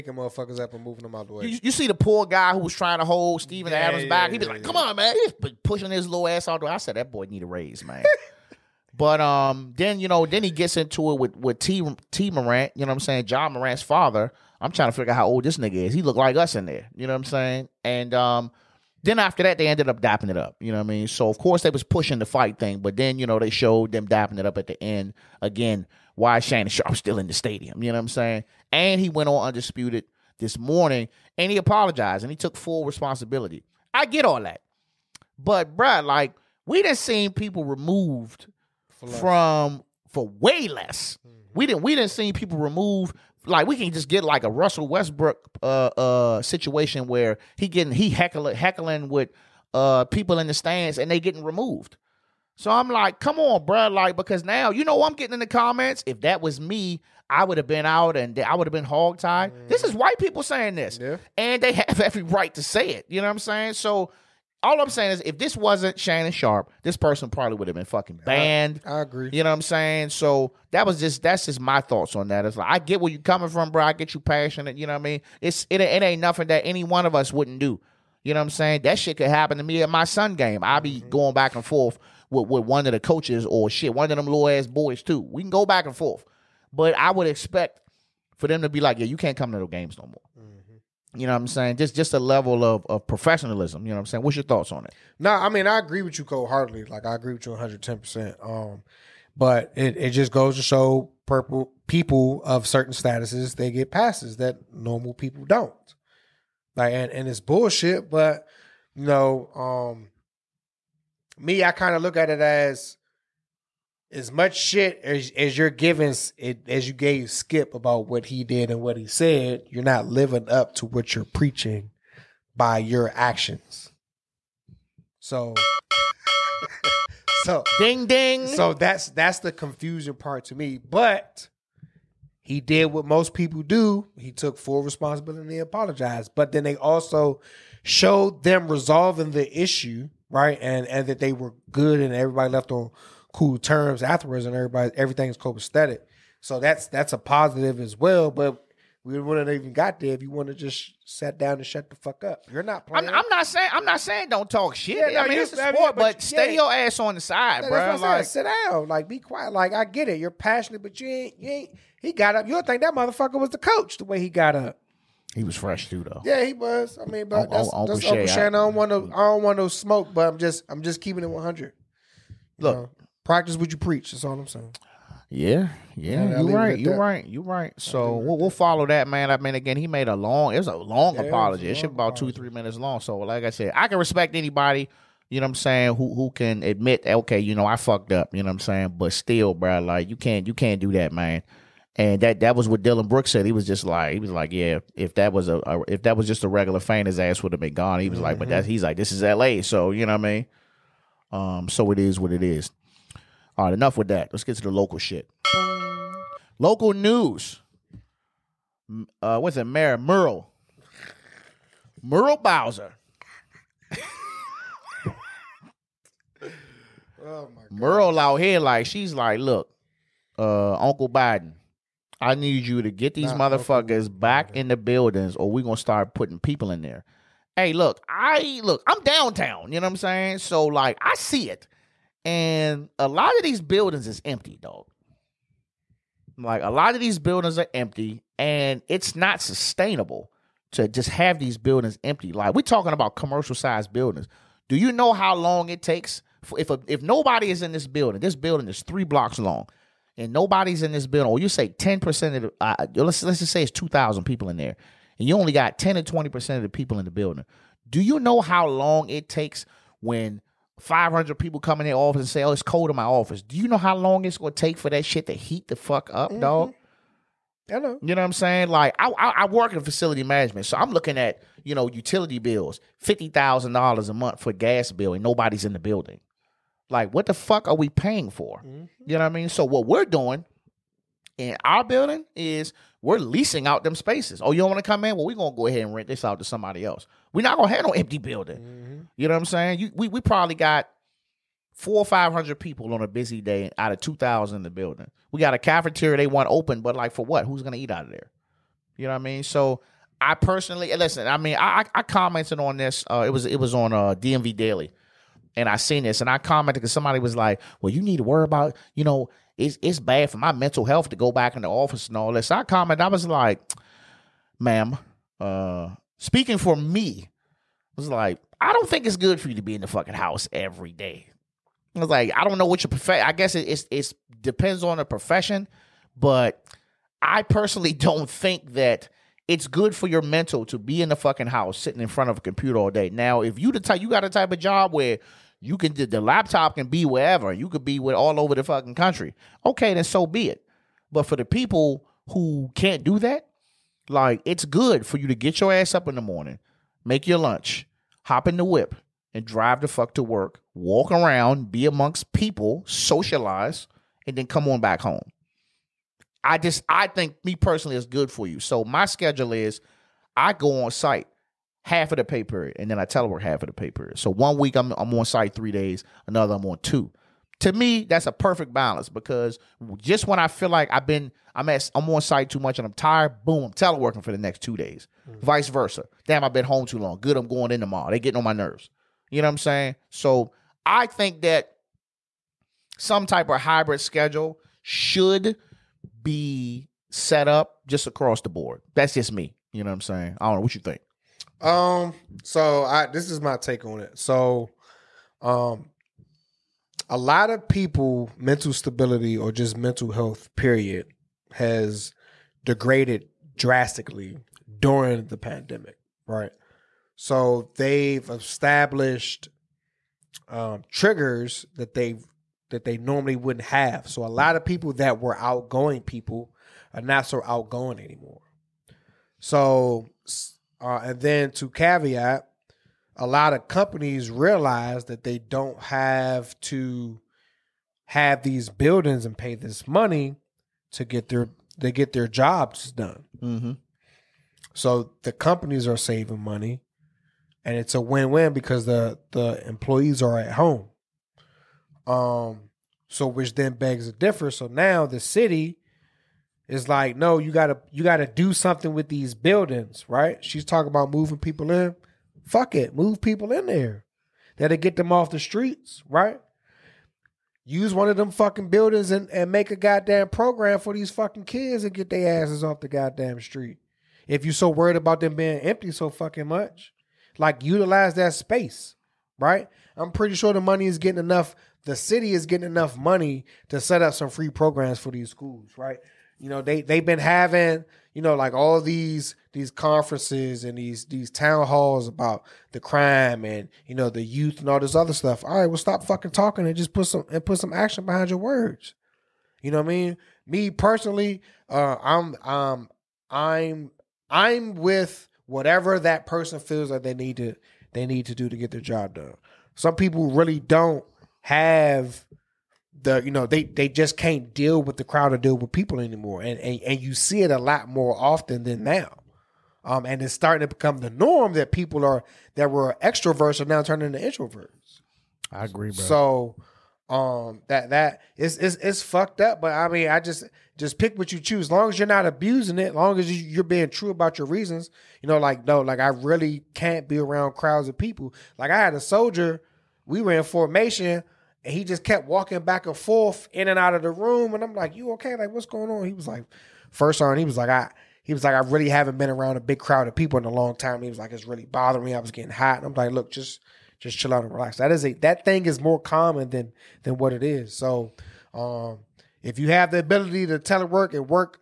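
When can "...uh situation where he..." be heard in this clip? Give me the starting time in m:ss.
0:45.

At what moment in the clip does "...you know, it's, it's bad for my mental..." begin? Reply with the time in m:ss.
5:08.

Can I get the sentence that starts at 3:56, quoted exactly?
Like a lot of these buildings are empty and it's not sustainable to just have these buildings empty.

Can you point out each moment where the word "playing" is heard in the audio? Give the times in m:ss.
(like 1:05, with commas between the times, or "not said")
2:32.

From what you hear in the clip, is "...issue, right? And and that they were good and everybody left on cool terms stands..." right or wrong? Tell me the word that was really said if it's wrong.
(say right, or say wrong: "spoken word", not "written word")
wrong: "afterwards", not "stands".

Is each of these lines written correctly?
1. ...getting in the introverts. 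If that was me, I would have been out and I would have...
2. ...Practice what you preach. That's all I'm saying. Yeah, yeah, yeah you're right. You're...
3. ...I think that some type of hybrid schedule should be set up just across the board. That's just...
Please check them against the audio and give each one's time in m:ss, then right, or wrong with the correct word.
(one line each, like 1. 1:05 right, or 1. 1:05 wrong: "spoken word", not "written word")
1. 0:55 wrong: "comments", not "introverts"
2. 2:53 right
3. 6:20 right.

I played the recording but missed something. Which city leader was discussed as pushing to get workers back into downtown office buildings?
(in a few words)
Muriel Bowser.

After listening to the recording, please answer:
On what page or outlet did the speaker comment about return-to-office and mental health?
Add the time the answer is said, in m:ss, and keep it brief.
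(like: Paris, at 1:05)
DMV Daily, at 5:04.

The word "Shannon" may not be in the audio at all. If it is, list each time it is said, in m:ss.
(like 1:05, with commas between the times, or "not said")
0:26, 1:05.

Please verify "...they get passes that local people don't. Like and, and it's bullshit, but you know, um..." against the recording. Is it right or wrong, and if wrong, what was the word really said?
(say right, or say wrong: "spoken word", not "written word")
wrong: "normal", not "local".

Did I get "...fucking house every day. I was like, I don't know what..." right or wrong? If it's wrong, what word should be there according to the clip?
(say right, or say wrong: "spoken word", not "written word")
right.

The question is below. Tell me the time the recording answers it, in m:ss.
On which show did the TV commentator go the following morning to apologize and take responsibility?
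0:29.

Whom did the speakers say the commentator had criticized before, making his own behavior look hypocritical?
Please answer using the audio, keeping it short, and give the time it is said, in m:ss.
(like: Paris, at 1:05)
Skip, at 1:57.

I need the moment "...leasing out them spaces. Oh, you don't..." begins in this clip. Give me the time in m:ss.
4:43.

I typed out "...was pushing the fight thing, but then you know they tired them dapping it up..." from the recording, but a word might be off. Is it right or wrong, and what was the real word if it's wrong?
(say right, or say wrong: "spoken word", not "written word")
wrong: "showed", not "tired".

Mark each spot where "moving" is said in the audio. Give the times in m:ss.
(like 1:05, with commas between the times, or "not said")
0:00, 7:31.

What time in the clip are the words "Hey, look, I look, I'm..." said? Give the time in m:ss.
3:47.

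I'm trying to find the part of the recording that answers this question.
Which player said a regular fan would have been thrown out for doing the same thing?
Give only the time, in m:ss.
3:12.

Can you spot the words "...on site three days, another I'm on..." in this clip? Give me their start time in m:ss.
6:05.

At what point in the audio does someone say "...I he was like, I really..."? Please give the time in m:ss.
8:57.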